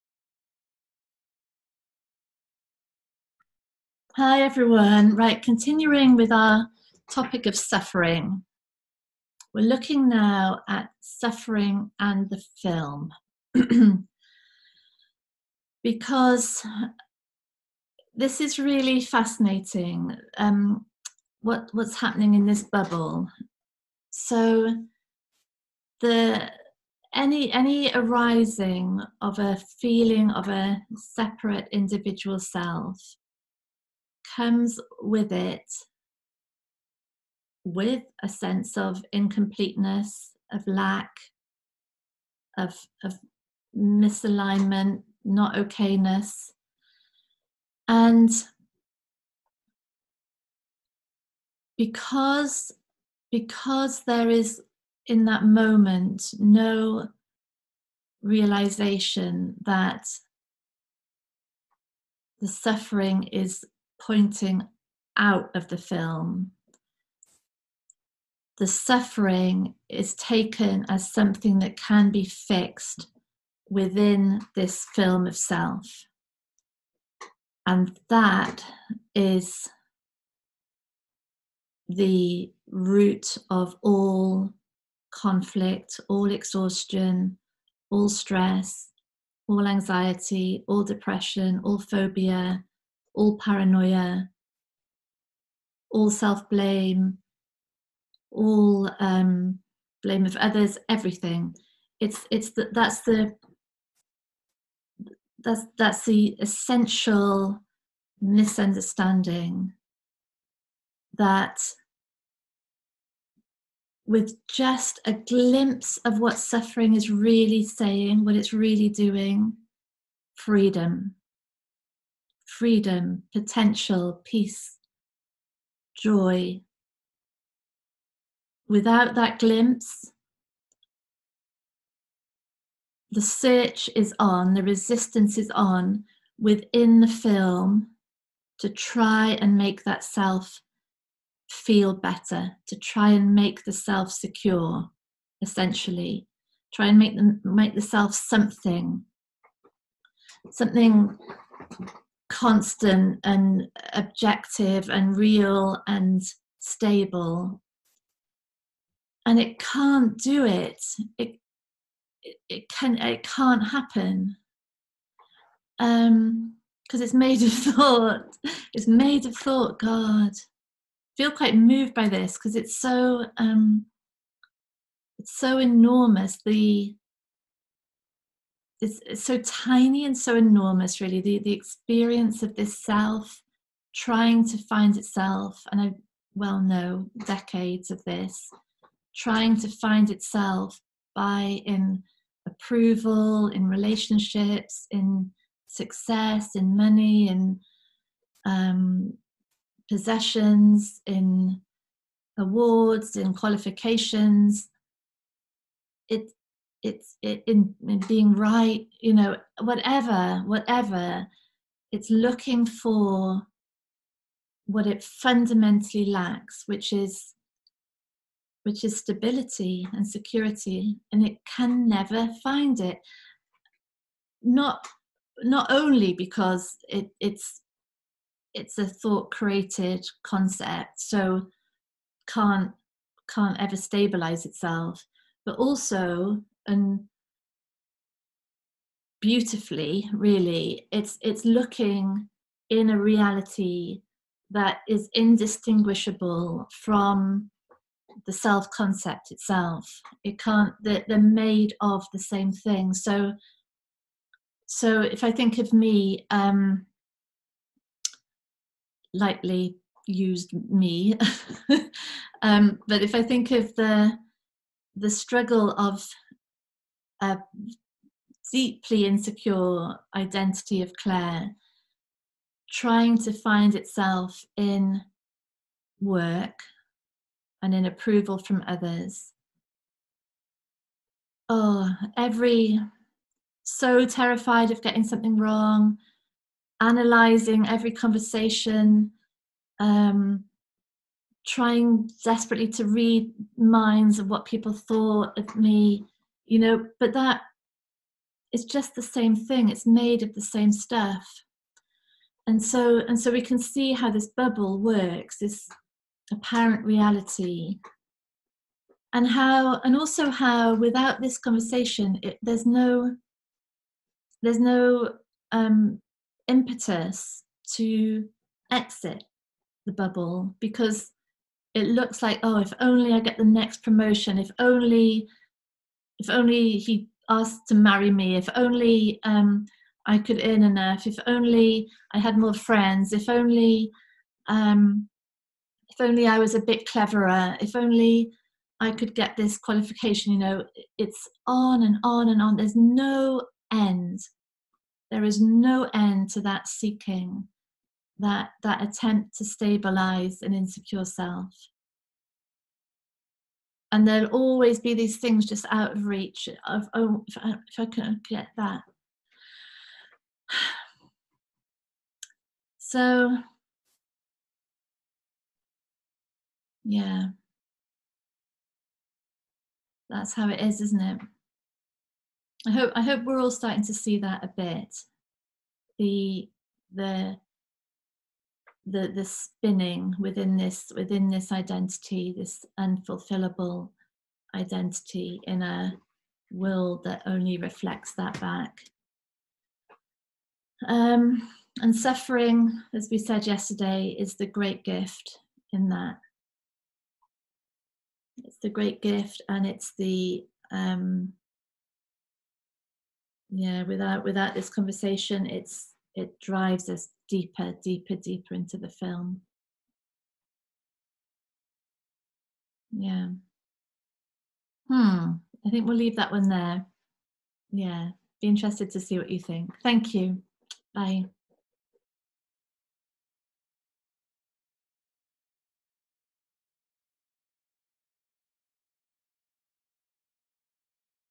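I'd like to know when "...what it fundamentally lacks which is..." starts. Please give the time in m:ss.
3:34.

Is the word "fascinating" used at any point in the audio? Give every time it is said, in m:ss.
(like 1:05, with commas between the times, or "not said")
0:18.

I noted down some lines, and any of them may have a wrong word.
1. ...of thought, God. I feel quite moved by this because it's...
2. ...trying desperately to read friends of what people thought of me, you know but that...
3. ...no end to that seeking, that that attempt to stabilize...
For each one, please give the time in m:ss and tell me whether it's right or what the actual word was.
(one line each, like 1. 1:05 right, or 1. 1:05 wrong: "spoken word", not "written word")
1. 2:49 right
2. 4:51 wrong: "minds", not "friends"
3. 5:45 right.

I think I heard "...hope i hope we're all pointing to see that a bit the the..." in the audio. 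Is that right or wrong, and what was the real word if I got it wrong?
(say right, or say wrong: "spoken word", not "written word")
wrong: "starting", not "pointing".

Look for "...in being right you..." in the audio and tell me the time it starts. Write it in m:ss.
3:27.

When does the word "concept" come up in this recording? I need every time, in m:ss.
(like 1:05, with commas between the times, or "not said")
3:50, 4:08.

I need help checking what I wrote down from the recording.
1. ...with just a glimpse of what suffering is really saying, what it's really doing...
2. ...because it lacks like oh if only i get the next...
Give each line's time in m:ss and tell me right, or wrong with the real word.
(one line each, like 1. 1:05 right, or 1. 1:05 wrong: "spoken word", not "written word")
1. 1:54 right
2. 5:20 wrong: "looks", not "lacks".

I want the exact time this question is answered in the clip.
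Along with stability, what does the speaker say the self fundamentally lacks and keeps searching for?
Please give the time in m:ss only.
3:40.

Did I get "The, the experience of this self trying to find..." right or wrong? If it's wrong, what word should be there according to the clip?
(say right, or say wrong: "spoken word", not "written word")
right.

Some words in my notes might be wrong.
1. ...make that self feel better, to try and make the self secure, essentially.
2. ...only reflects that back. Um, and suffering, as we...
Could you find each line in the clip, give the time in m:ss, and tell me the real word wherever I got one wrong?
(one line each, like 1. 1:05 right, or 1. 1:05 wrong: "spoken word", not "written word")
1. 2:19 right
2. 6:27 right.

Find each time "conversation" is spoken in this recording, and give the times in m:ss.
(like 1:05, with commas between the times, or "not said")
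4:47, 5:11, 6:44.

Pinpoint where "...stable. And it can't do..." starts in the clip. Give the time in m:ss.
2:36.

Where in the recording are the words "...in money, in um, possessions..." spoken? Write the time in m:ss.
3:16.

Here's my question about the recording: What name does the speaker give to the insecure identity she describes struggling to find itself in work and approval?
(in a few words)
Clare.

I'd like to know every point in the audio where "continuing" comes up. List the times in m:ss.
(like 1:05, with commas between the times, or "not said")
0:05.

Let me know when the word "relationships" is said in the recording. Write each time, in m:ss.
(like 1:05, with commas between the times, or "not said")
3:13.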